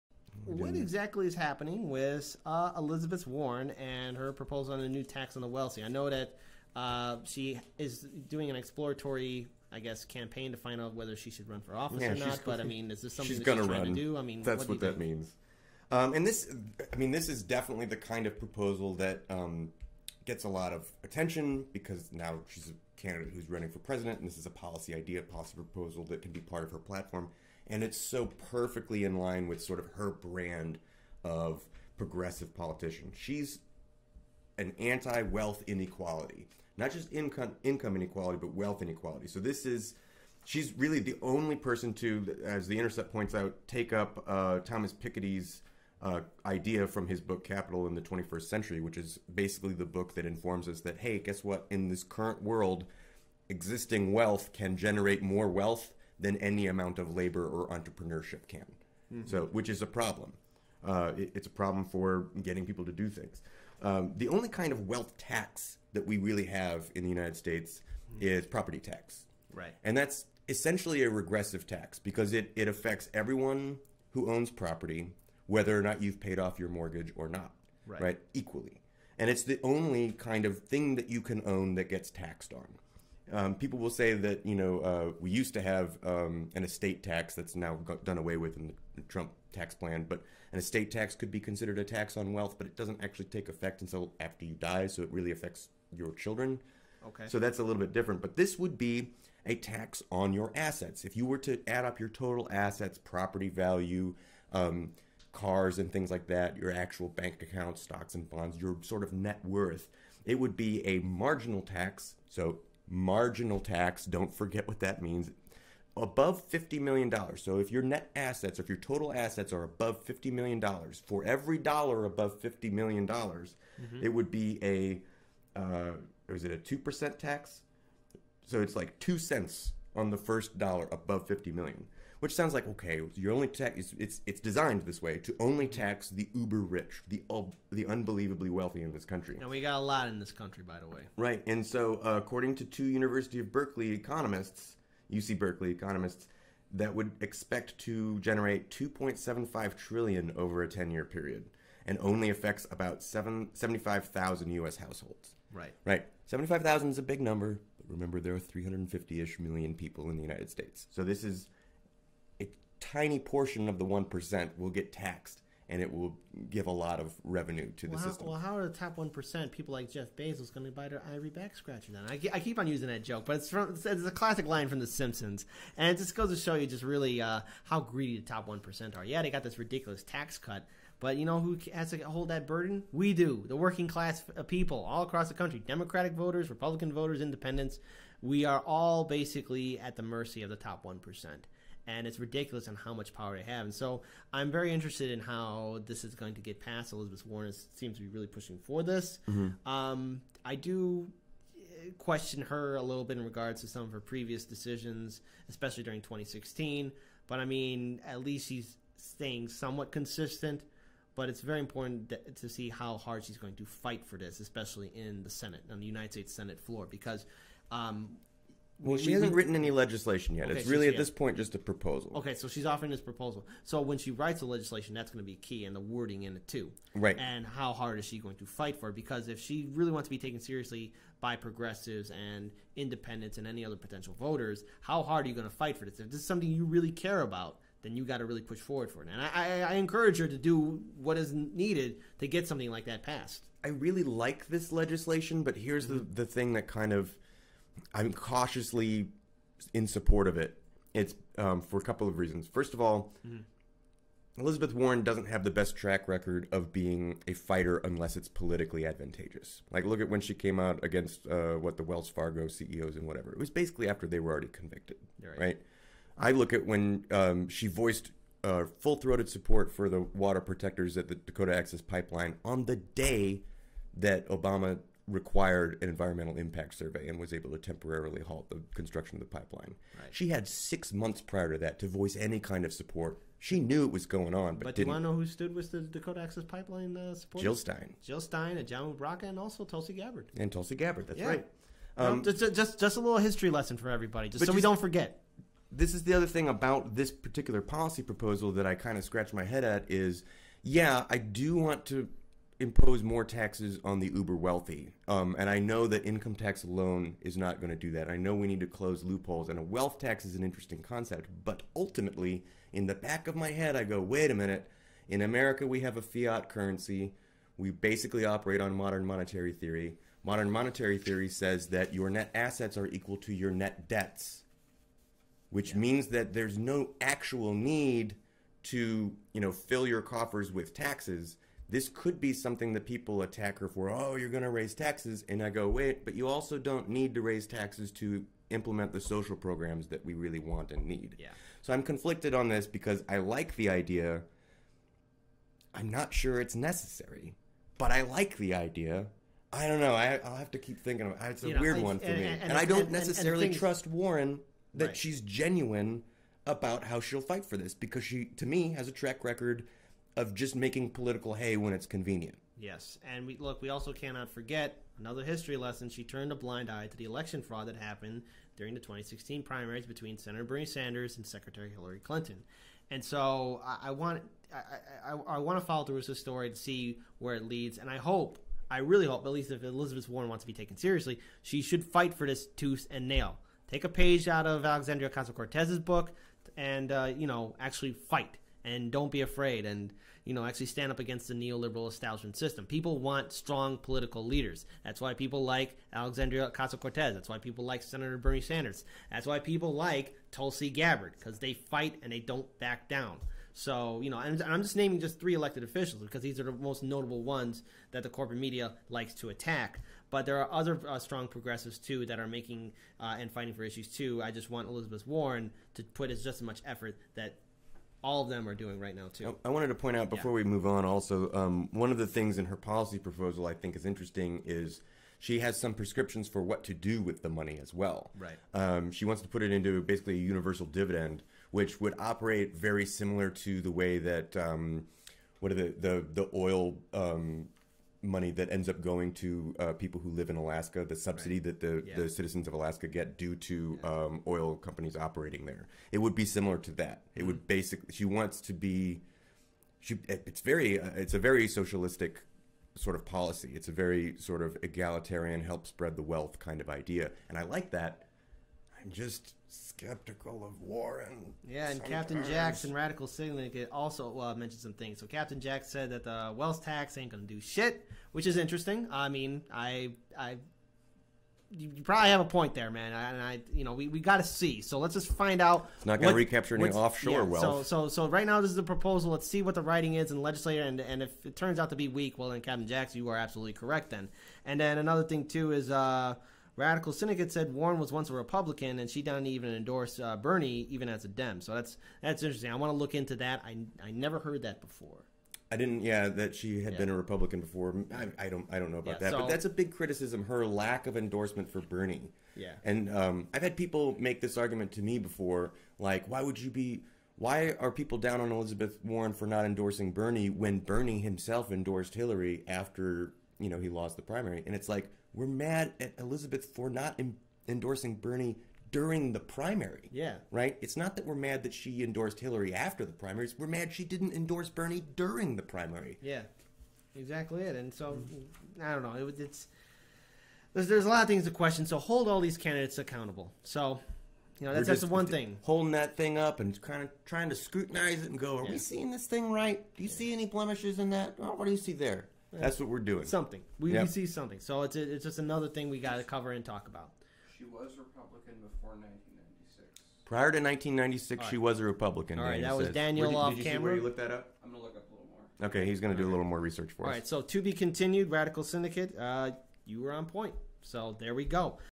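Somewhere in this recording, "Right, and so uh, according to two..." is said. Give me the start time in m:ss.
2:21.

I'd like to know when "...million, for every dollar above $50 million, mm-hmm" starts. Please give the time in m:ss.
2:00.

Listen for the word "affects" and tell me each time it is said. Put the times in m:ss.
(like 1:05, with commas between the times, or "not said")
1:12, 1:35, 2:32.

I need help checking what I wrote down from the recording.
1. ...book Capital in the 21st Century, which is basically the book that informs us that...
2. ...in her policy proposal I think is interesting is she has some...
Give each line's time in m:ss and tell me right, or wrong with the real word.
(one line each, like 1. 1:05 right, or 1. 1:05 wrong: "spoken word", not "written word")
1. 0:47 right
2. 7:02 right.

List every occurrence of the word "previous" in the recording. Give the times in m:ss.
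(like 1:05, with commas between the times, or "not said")
3:23.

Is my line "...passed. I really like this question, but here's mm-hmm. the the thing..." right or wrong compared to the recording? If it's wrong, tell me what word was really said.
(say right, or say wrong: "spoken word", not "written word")
wrong: "legislation", not "question".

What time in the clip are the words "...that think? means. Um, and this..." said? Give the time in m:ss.
0:14.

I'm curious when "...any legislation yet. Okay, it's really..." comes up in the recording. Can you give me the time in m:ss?
3:39.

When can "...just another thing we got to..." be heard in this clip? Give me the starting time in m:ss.
9:05.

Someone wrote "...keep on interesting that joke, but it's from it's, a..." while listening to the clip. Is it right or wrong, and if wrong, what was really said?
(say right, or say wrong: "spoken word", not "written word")
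wrong: "using", not "interesting".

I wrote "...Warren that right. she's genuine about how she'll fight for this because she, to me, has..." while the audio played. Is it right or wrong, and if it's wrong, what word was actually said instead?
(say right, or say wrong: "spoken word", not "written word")
right.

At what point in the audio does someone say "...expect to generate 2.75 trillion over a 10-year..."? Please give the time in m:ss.
2:27.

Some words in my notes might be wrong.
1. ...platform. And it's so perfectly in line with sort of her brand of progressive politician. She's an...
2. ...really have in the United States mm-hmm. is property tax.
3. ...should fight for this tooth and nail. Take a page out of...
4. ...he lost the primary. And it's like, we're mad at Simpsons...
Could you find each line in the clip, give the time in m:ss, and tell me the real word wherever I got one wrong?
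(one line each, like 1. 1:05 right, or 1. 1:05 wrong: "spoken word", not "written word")
1. 0:26 right
2. 1:06 right
3. 6:21 right
4. 8:33 wrong: "Elizabeth", not "Simpsons".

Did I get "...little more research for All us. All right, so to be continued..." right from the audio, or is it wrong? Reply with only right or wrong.
right.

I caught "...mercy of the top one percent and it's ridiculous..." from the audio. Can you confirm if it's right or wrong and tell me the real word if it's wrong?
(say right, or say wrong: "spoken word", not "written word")
right.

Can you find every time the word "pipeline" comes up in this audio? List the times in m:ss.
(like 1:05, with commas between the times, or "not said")
4:31, 4:39, 4:46.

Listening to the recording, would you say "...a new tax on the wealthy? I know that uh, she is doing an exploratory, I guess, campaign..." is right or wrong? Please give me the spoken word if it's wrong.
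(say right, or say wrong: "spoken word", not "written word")
right.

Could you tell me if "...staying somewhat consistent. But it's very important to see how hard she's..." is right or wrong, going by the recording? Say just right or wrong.
right.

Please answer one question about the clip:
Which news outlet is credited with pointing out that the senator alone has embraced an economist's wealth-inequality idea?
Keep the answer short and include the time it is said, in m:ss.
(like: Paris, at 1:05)
The Intercept, at 0:42.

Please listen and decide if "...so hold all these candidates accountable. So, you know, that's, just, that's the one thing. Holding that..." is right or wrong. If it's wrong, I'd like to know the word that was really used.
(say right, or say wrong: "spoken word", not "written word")
right.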